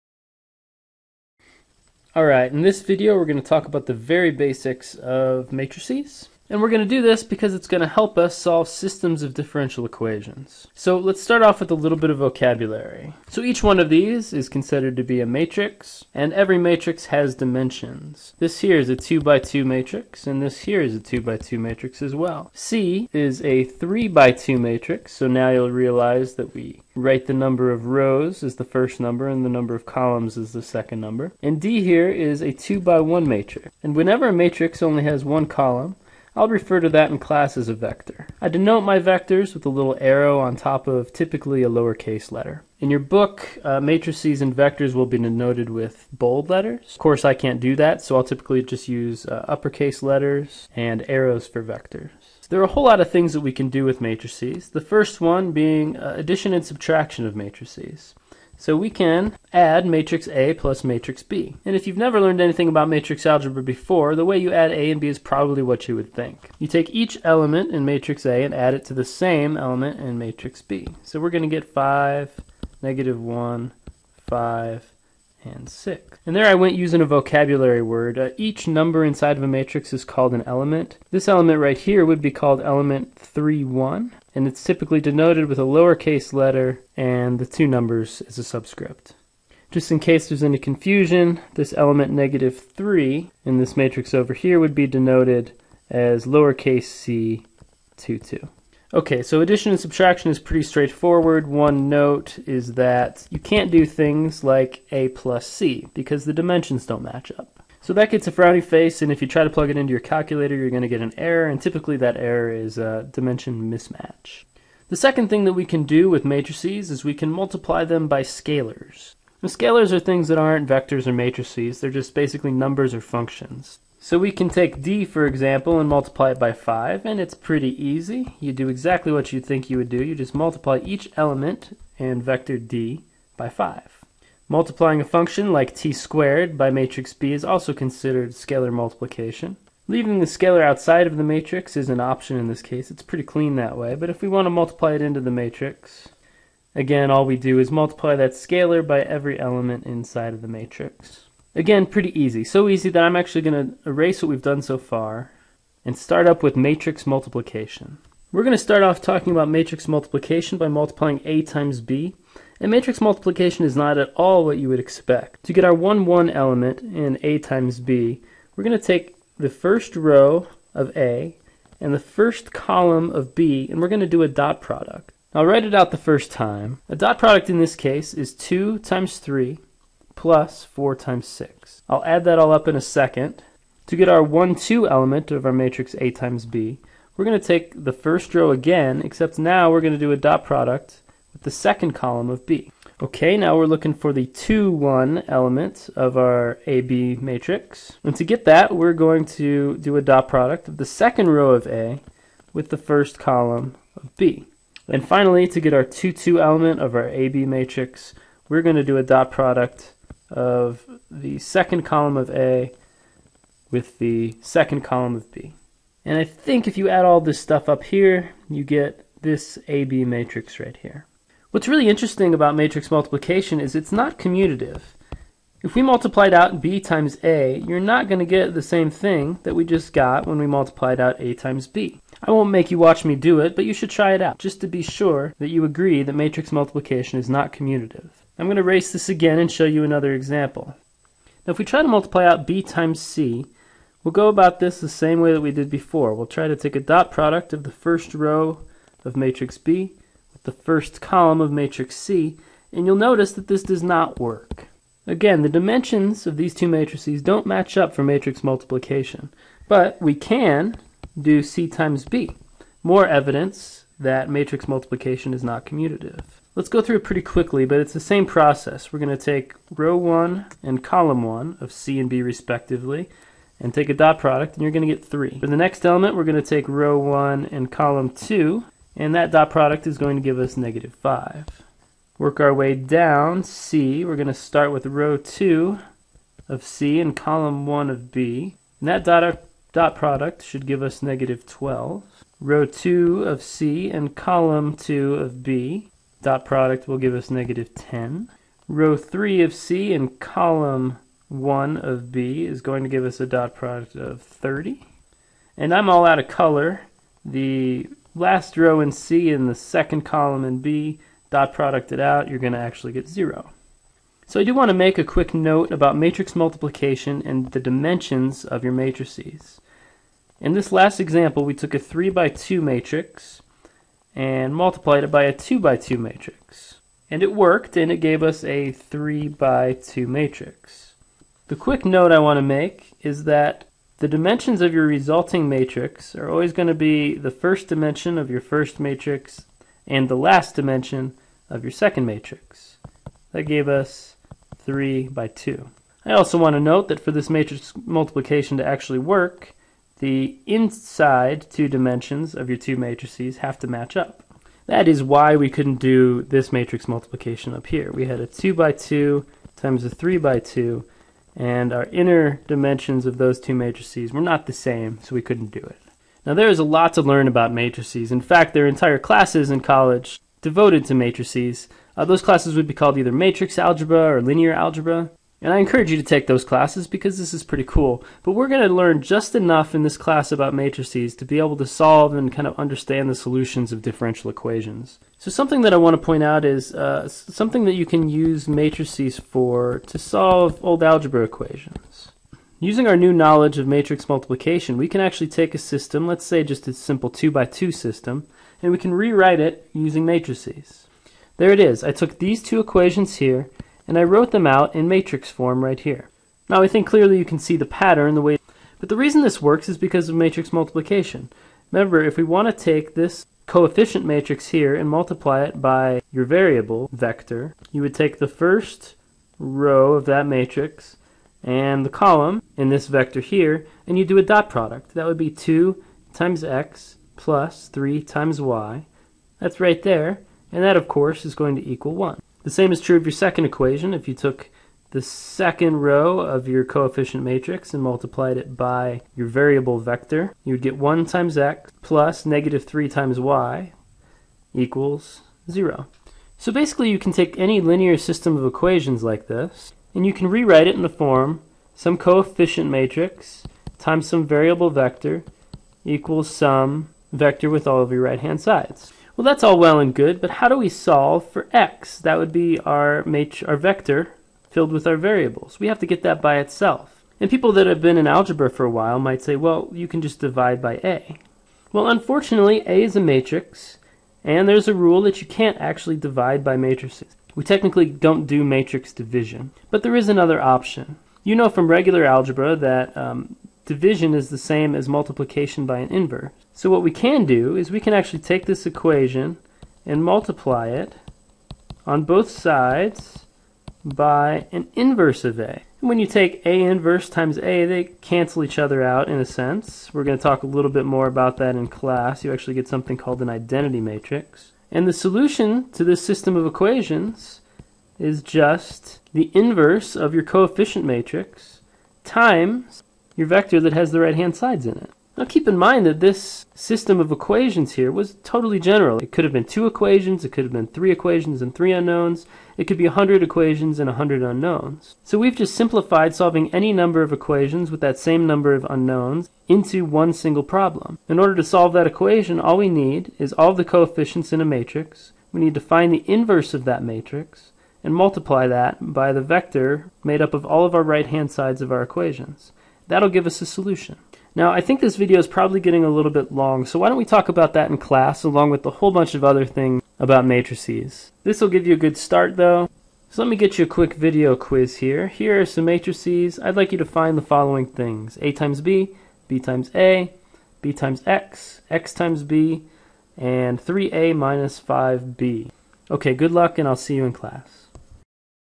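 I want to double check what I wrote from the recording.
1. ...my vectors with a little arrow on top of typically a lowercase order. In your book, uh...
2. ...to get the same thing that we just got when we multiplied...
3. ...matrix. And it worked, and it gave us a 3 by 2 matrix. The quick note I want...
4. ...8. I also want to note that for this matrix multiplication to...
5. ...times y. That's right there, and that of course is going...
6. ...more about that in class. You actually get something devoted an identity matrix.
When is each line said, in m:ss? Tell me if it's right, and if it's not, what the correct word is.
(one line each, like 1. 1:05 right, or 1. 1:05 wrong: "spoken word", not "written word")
1. 0:38 wrong: "letter", not "order"
2. 3:48 right
3. 5:25 right
4. 5:45 wrong: "2", not "8"
5. 7:08 right
6. 8:20 wrong: "called", not "devoted".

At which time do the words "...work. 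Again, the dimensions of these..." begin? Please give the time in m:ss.
4:14.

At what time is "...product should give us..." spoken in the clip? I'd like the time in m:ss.
4:49.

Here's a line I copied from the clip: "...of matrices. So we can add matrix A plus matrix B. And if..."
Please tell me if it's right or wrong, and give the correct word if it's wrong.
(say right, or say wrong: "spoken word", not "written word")
right.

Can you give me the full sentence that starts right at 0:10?
So let's start off with a little bit of vocabulary.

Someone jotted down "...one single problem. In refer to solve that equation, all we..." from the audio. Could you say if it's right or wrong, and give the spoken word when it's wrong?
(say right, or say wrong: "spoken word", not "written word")
wrong: "order", not "refer".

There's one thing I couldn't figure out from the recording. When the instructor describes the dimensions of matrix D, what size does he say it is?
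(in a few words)
2 by 1.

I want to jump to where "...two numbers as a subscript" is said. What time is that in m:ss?
1:27.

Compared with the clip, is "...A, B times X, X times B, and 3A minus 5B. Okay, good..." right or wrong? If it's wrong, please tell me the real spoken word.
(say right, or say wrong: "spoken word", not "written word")
right.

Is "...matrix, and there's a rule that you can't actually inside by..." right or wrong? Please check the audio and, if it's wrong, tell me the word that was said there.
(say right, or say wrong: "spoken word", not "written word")
wrong: "divide", not "inside".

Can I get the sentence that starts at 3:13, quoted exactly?
Okay, now we're looking for the 2, 1 element of our AB matrix.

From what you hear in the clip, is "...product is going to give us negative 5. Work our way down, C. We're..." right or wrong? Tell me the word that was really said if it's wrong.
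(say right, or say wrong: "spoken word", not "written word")
right.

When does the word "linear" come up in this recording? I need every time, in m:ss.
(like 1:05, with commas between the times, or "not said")
6:14, 7:27.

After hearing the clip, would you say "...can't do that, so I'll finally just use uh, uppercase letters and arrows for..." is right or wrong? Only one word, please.
wrong.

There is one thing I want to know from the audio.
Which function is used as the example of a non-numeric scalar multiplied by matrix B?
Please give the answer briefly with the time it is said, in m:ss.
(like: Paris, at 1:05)
t squared, at 2:15.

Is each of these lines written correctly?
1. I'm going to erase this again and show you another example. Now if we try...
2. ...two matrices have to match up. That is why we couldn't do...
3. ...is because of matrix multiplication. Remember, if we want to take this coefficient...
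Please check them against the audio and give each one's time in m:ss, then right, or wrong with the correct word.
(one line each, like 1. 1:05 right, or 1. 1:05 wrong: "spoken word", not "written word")
1. 3:58 right
2. 5:52 right
3. 6:49 right.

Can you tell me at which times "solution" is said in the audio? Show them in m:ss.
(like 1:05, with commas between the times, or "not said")
6:23, 8:24, 9:03.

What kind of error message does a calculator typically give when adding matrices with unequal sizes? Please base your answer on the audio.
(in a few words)
dimension mismatch.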